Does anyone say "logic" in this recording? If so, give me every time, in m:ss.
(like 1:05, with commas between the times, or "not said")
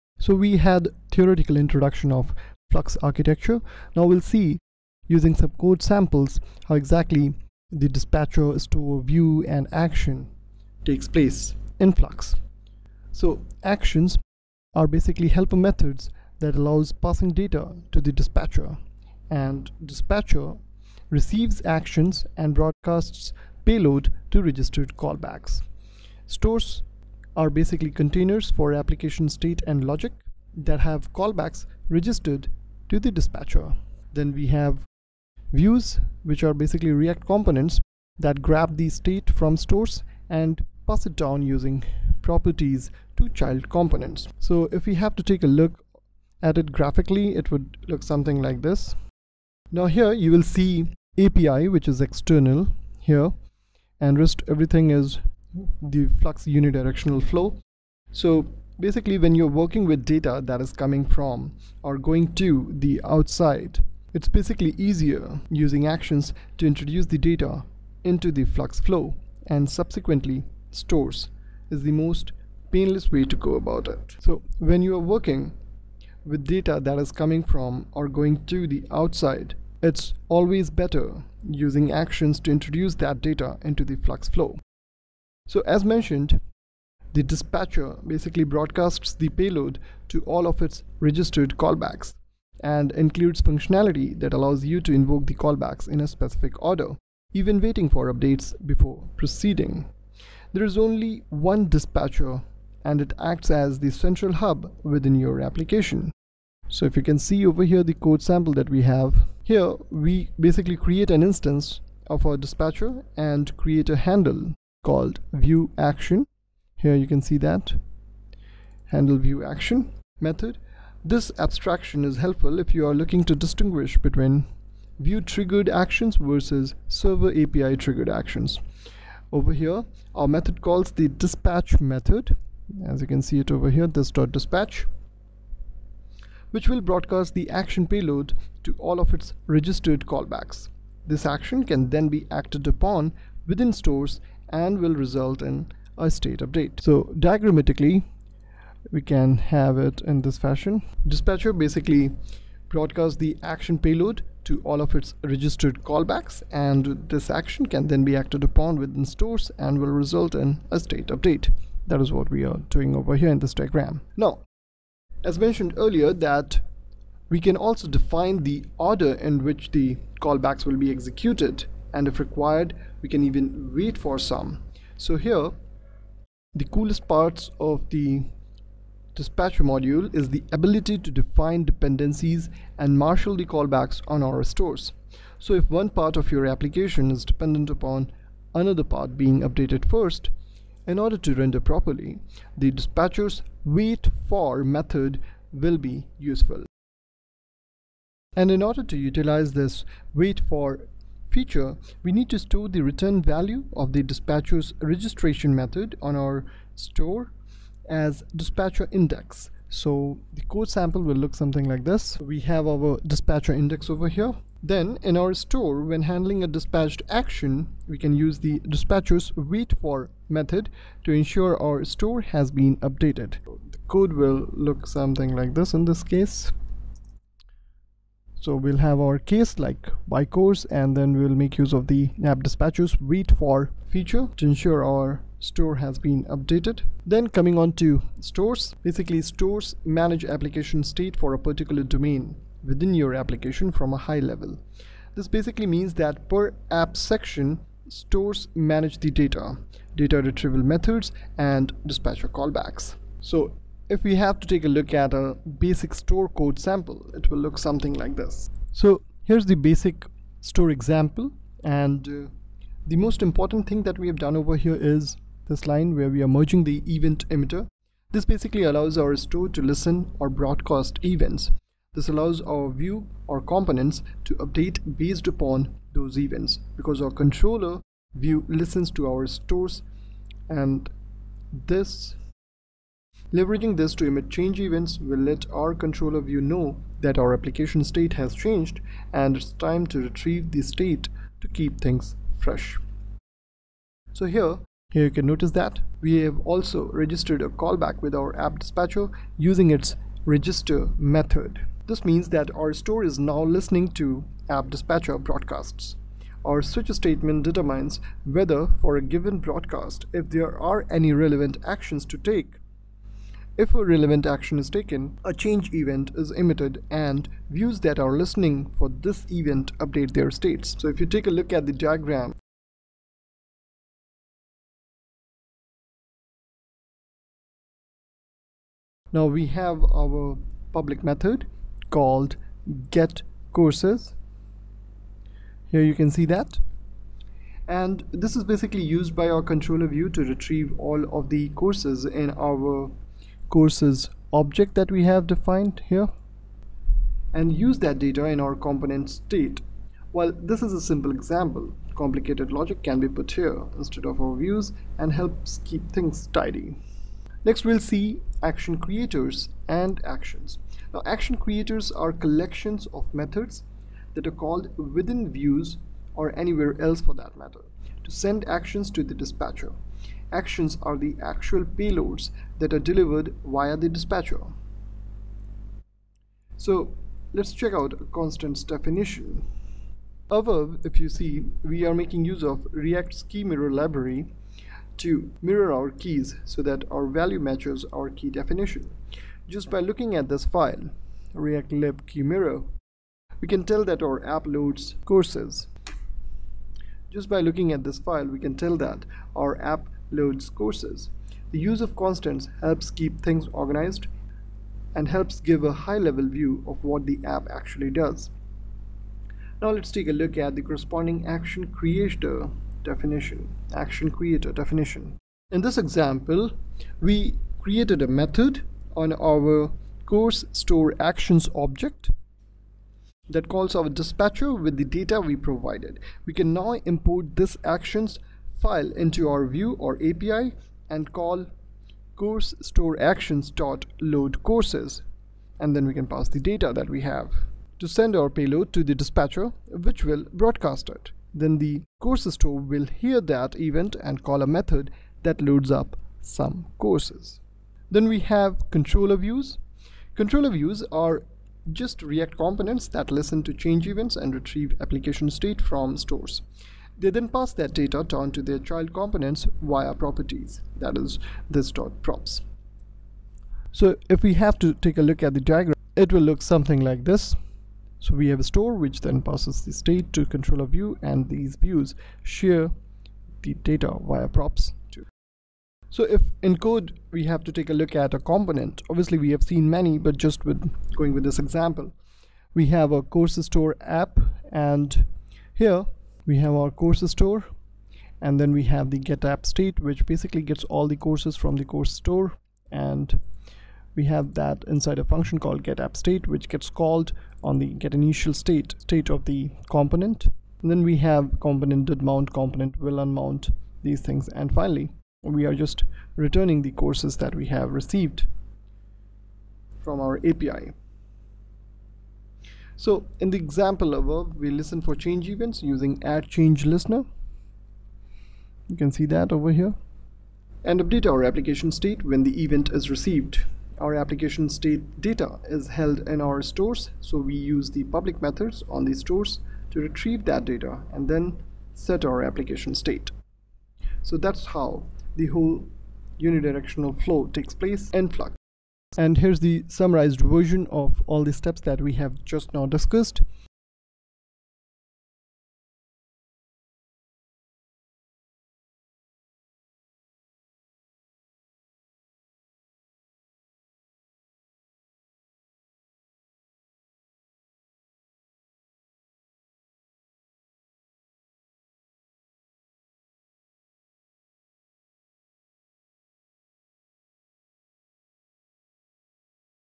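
0:29, 5:52.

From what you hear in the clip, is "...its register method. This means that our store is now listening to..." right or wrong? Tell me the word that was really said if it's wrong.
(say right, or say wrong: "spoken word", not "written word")
right.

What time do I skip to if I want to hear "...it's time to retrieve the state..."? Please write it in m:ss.
4:49.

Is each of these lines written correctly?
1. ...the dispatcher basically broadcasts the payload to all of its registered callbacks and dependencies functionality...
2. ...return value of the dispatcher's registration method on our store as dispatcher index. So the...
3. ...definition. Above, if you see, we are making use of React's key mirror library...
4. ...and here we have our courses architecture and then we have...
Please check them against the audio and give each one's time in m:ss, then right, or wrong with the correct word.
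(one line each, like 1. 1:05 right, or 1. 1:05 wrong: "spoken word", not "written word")
1. 1:27 wrong: "includes", not "dependencies"
2. 3:22 right
3. 6:18 right
4. 8:04 wrong: "store", not "architecture".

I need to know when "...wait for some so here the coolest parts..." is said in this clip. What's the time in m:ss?
2:53.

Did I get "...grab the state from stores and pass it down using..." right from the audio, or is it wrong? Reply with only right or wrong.
right.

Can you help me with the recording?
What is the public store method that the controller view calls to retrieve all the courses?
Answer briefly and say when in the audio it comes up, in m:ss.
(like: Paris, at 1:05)
get courses, at 5:32.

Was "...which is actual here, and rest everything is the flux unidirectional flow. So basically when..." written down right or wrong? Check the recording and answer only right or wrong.
wrong.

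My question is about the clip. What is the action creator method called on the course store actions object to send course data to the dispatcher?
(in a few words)
load courses.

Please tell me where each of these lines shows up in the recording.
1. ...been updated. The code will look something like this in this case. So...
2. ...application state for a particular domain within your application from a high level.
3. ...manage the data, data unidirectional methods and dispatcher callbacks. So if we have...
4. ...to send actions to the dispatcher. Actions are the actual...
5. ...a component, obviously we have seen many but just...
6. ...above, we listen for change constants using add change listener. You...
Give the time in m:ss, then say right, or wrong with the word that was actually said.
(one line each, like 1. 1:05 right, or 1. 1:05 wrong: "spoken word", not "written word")
1. 3:42 right
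2. 4:00 right
3. 4:08 wrong: "retrieval", not "unidirectional"
4. 6:08 right
5. 7:58 right
6. 8:33 wrong: "events", not "constants".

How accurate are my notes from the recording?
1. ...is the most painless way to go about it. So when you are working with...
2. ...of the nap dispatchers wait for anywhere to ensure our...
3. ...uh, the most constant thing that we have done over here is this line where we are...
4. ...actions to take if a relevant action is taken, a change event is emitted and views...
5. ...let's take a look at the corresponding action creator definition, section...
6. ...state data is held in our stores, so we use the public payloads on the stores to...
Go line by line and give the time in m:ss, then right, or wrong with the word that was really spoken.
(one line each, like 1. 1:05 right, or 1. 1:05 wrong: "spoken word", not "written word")
1. 1:11 right
2. 3:51 wrong: "feature", not "anywhere"
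3. 4:22 wrong: "important", not "constant"
4. 5:11 right
5. 6:49 wrong: "action", not "section"
6. 8:44 wrong: "methods", not "payloads".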